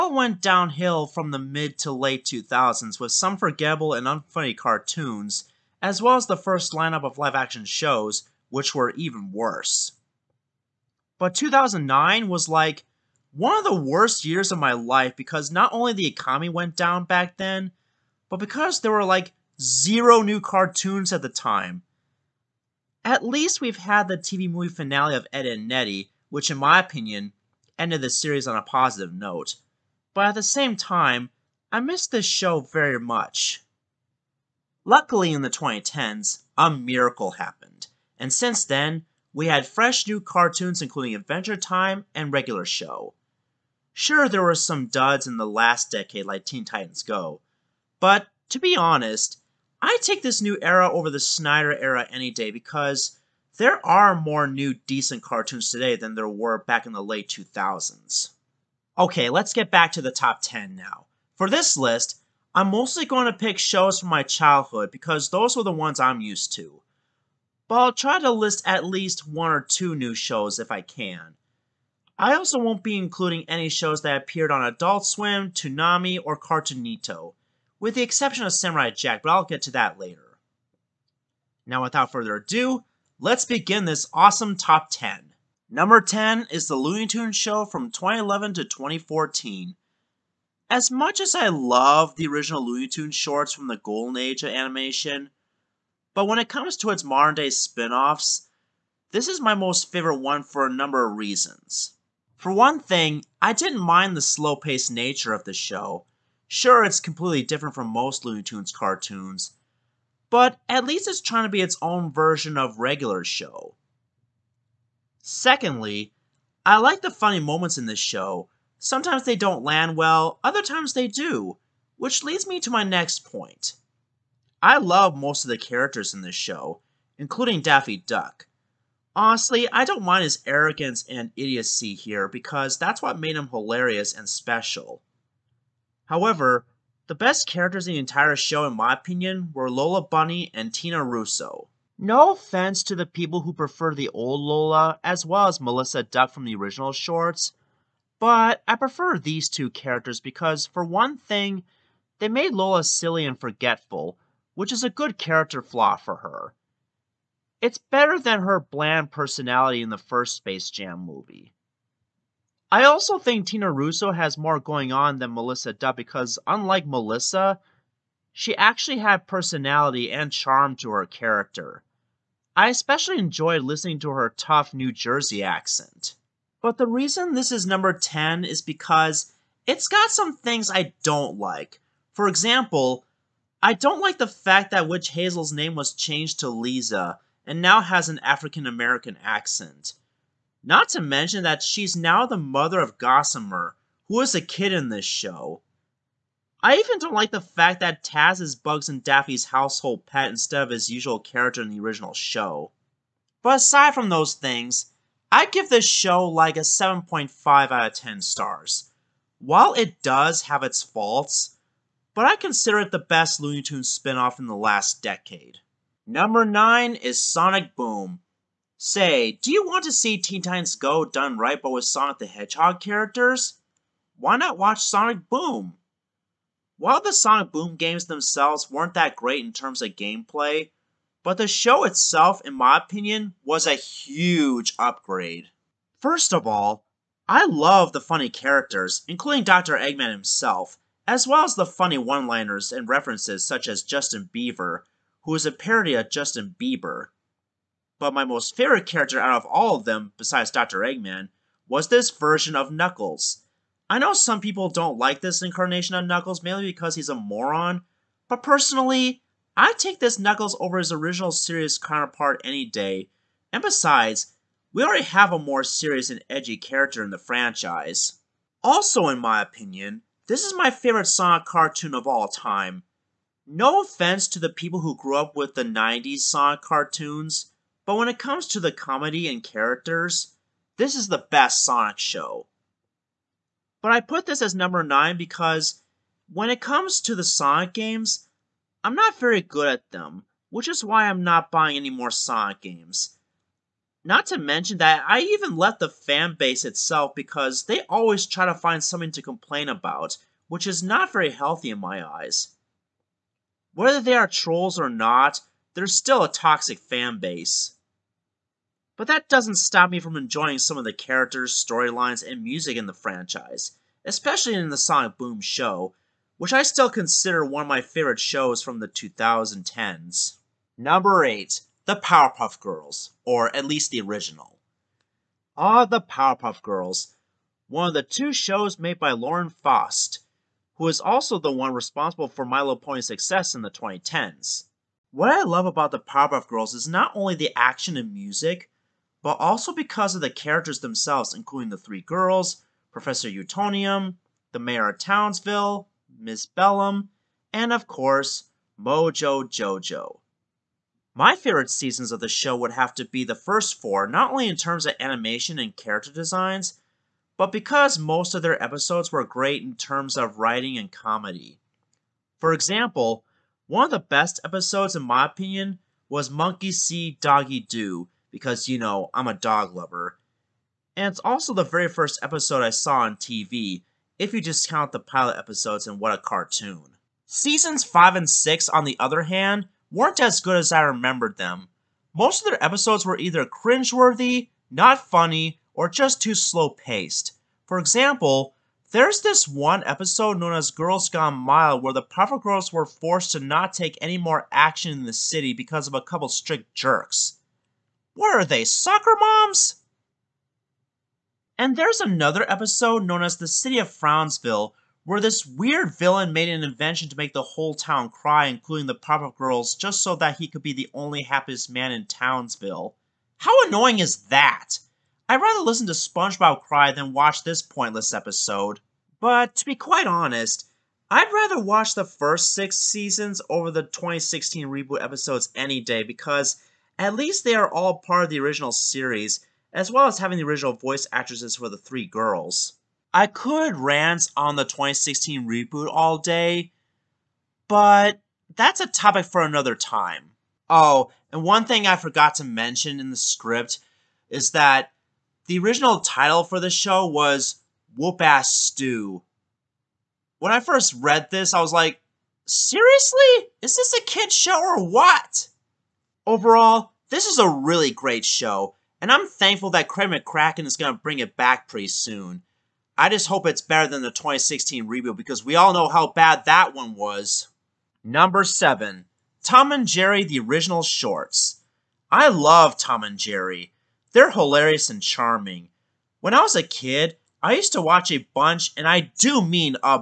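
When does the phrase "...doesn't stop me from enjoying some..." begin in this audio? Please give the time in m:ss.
5:09.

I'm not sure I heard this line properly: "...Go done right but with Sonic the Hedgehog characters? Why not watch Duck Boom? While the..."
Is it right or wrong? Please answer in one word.
wrong.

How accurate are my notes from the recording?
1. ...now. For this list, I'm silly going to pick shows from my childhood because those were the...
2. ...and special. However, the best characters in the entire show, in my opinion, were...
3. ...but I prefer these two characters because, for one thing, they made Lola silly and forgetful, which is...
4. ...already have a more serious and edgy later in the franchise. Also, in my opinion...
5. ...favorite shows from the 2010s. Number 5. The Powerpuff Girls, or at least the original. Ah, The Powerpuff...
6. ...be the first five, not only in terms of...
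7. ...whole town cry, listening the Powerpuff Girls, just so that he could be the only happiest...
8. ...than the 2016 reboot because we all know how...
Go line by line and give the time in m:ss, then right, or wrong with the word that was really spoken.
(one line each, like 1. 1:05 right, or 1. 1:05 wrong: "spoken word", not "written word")
1. 1:00 wrong: "mostly", not "silly"
2. 2:14 right
3. 2:28 right
4. 4:24 wrong: "character", not "later"
5. 5:17 wrong: "8", not "5"
6. 5:53 wrong: "four", not "five"
7. 6:47 wrong: "including", not "listening"
8. 7:43 right.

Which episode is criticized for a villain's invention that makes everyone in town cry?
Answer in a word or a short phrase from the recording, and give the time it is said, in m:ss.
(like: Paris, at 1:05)
The City of Frownsville, at 6:43.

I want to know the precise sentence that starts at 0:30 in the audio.
But at the same time, I miss this show very much.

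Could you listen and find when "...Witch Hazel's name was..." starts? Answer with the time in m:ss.
3:04.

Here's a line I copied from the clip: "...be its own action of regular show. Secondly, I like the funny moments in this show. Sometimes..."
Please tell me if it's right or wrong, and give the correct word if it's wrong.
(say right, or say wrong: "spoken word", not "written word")
wrong: "version", not "action".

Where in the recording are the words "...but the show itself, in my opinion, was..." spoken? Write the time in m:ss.
3:51.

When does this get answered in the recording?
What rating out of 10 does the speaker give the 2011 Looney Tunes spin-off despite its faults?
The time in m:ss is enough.
3:26.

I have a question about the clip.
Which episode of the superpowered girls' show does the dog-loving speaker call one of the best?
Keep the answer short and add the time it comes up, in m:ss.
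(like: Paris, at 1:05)
Monkey See, Doggy Do, at 6:06.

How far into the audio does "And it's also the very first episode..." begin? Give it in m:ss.
6:10.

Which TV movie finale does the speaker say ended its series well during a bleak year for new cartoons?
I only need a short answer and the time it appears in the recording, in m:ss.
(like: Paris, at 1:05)
Ed and Eddy, at 0:25.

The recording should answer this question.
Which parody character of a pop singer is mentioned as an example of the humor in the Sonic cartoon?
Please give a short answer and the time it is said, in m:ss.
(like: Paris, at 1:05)
Justin Beaver, at 4:03.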